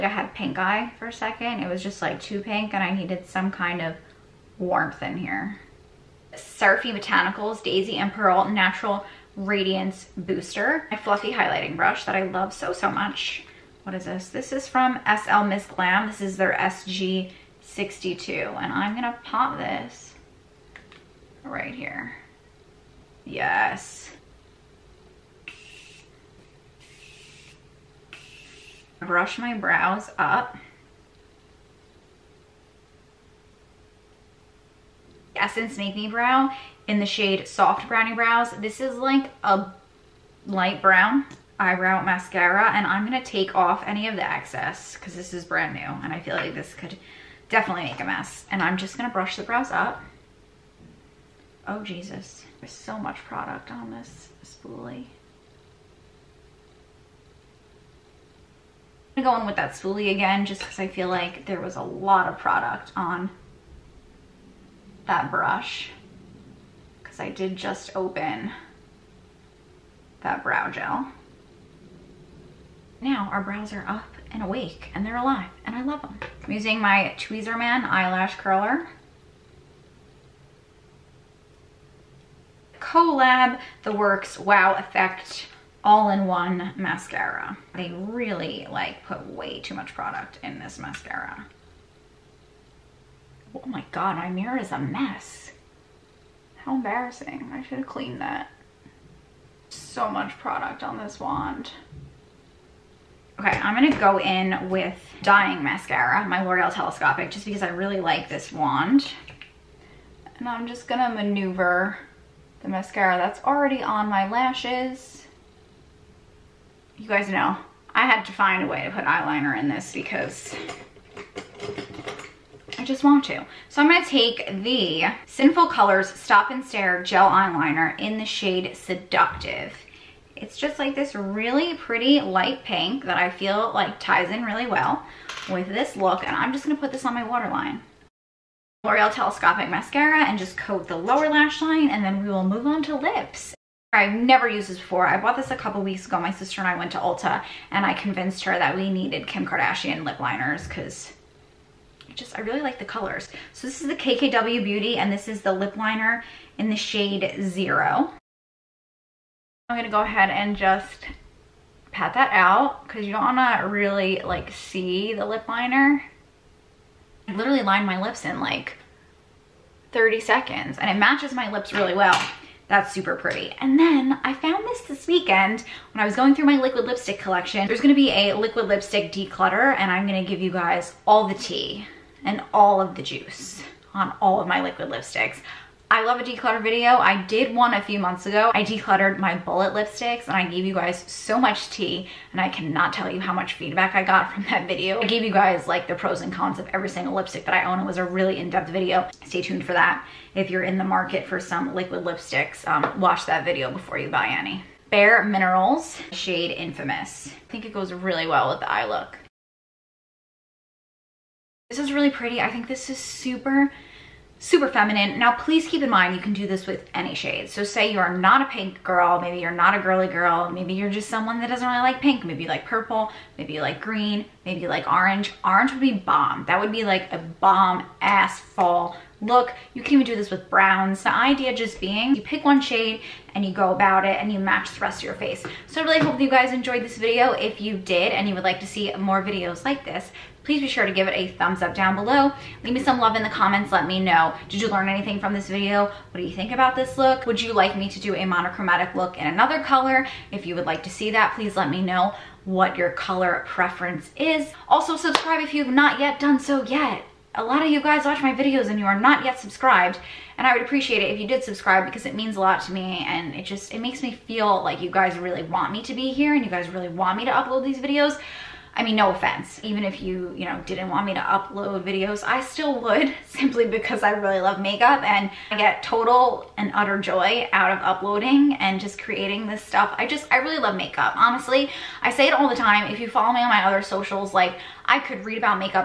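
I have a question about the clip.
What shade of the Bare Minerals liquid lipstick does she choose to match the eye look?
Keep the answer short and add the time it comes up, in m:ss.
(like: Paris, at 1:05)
Infamous, at 3:26.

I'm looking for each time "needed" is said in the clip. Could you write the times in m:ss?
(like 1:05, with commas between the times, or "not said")
0:02, 2:28.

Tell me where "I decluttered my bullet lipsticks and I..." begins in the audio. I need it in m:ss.
3:08.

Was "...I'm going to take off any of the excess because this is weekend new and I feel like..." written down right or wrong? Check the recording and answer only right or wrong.
wrong.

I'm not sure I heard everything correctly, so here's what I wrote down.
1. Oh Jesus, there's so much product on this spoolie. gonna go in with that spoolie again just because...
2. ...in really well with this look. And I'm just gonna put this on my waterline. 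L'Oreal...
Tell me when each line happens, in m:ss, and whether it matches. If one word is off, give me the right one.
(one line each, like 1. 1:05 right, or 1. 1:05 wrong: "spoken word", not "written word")
1. 0:51 right
2. 2:14 right.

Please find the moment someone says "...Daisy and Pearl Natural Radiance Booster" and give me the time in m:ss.
0:07.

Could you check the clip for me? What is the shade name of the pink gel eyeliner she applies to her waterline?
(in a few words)
Seductive.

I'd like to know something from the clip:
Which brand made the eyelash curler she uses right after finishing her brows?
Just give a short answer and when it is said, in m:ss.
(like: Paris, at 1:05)
Tweezerman, at 1:17.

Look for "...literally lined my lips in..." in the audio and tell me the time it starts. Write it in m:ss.
2:47.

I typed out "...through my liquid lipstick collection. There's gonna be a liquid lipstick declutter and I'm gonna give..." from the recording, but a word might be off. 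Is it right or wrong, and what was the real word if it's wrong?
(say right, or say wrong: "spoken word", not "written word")
right.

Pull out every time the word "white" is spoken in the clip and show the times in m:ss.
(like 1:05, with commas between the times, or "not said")
not said.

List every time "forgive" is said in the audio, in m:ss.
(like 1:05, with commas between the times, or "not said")
not said.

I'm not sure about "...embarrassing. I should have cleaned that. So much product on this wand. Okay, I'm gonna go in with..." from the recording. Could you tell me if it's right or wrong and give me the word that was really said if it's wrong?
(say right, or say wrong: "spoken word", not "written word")
right.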